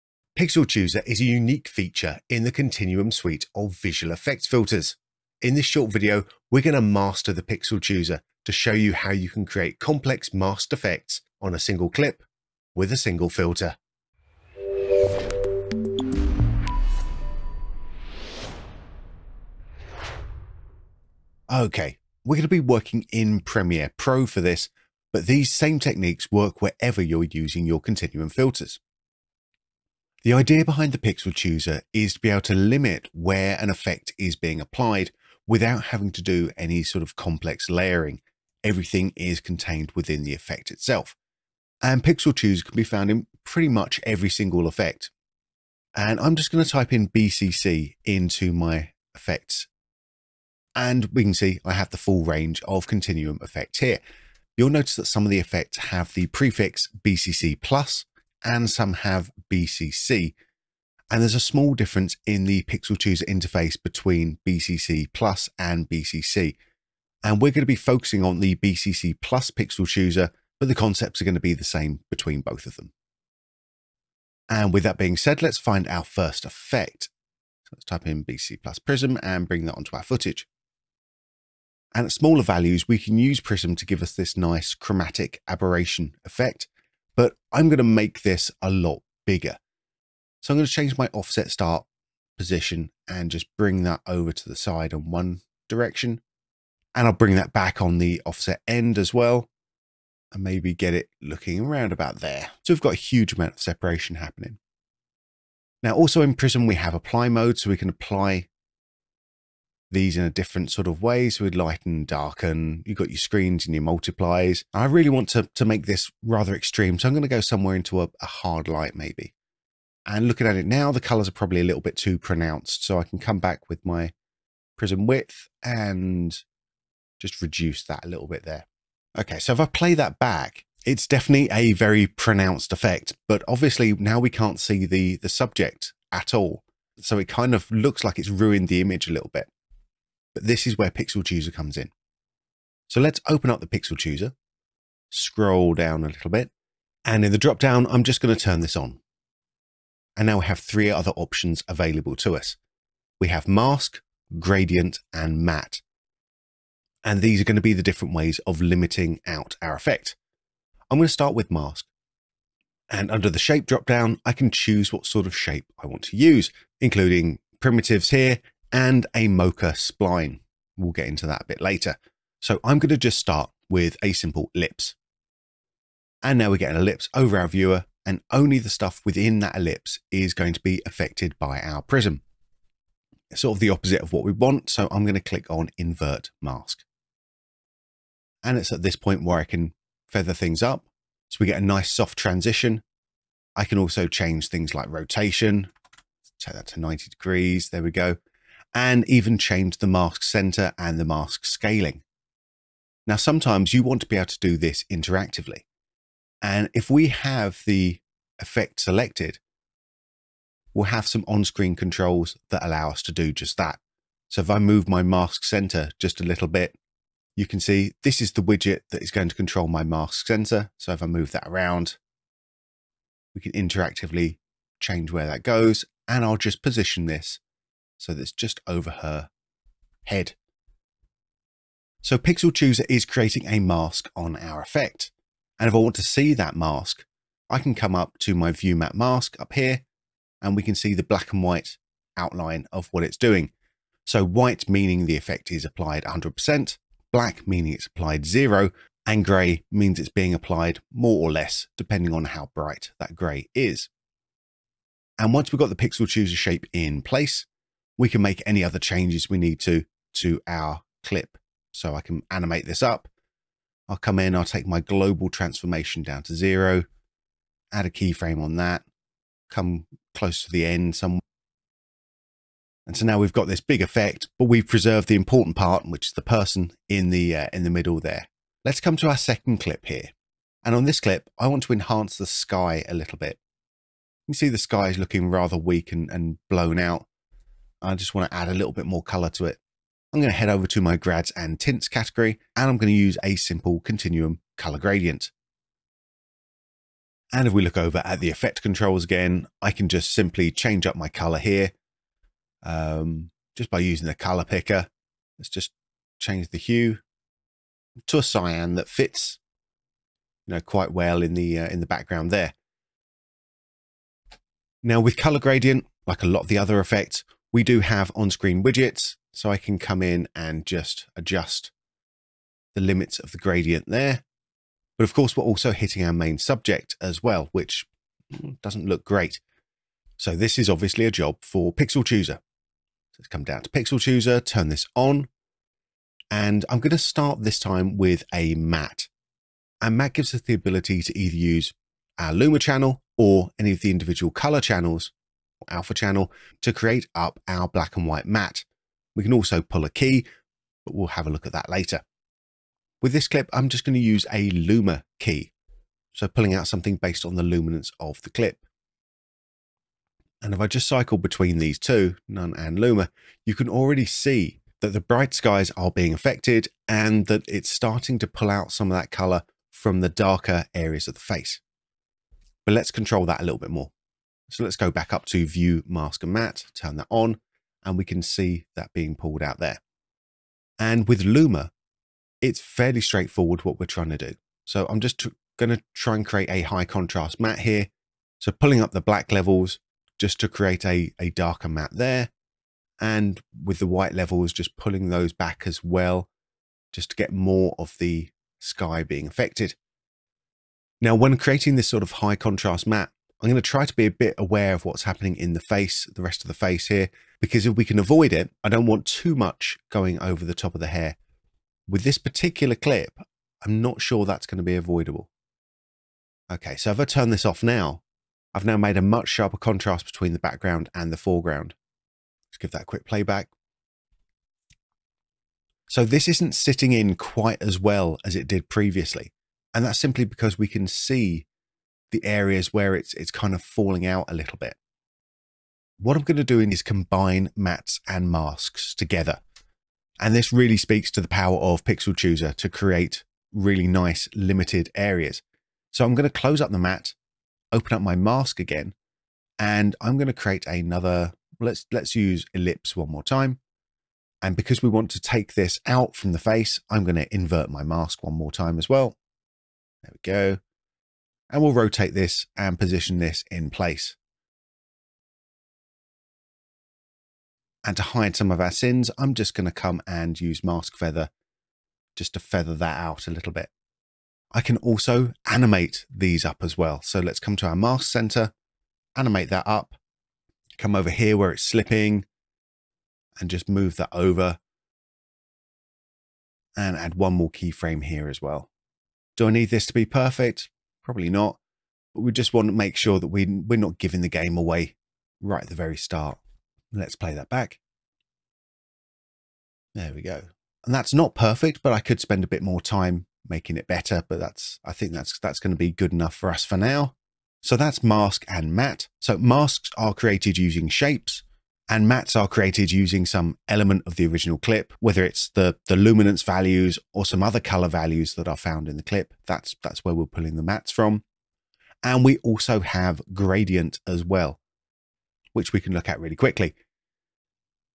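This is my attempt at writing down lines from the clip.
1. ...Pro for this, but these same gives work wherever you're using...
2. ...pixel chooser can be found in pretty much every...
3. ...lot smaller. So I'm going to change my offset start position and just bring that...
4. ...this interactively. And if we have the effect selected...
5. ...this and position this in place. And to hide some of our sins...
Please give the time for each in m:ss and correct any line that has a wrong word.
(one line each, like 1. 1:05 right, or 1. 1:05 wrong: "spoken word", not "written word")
1. 0:23 wrong: "techniques", not "gives"
2. 0:42 right
3. 1:28 wrong: "bigger", not "smaller"
4. 3:24 right
5. 7:42 right.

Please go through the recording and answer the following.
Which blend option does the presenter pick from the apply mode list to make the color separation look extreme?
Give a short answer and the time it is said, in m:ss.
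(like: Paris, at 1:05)
Hard light, at 1:58.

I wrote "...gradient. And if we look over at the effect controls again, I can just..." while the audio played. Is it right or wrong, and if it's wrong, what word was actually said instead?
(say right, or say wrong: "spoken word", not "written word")
right.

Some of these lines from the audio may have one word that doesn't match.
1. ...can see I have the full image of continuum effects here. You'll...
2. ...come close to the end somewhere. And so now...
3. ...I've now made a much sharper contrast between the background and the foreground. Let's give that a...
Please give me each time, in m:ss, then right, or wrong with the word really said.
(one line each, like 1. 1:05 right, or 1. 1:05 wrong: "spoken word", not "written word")
1. 0:51 wrong: "range", not "image"
2. 4:29 right
3. 6:58 right.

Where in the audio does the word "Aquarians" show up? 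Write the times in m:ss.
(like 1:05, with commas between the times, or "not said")
not said.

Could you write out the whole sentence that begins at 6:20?
And with Luma, it's fairly straightforward what we're trying to do.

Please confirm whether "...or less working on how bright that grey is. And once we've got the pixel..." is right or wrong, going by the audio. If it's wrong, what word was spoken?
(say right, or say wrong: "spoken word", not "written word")
wrong: "depending", not "working".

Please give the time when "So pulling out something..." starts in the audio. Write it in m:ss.
5:56.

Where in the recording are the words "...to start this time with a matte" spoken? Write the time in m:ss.
5:36.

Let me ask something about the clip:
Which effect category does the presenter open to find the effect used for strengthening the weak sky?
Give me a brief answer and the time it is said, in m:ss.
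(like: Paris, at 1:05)
Grads and tints, at 4:50.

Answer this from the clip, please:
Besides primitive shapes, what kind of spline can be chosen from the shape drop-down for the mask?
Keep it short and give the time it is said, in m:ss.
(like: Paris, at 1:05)
Mocha spline, at 2:49.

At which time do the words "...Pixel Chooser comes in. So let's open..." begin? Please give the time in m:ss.
2:20.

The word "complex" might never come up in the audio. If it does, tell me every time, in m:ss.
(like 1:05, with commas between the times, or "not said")
0:09, 0:37.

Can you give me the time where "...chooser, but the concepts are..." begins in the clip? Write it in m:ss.
1:09.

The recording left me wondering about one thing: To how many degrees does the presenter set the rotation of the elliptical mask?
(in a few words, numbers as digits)
90.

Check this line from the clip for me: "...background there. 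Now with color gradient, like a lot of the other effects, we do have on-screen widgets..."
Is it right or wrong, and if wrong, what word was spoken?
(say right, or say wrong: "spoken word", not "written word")
right.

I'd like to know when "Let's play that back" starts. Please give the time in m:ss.
8:16.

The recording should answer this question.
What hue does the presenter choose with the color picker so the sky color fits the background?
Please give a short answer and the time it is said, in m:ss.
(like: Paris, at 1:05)
Cyan, at 5:08.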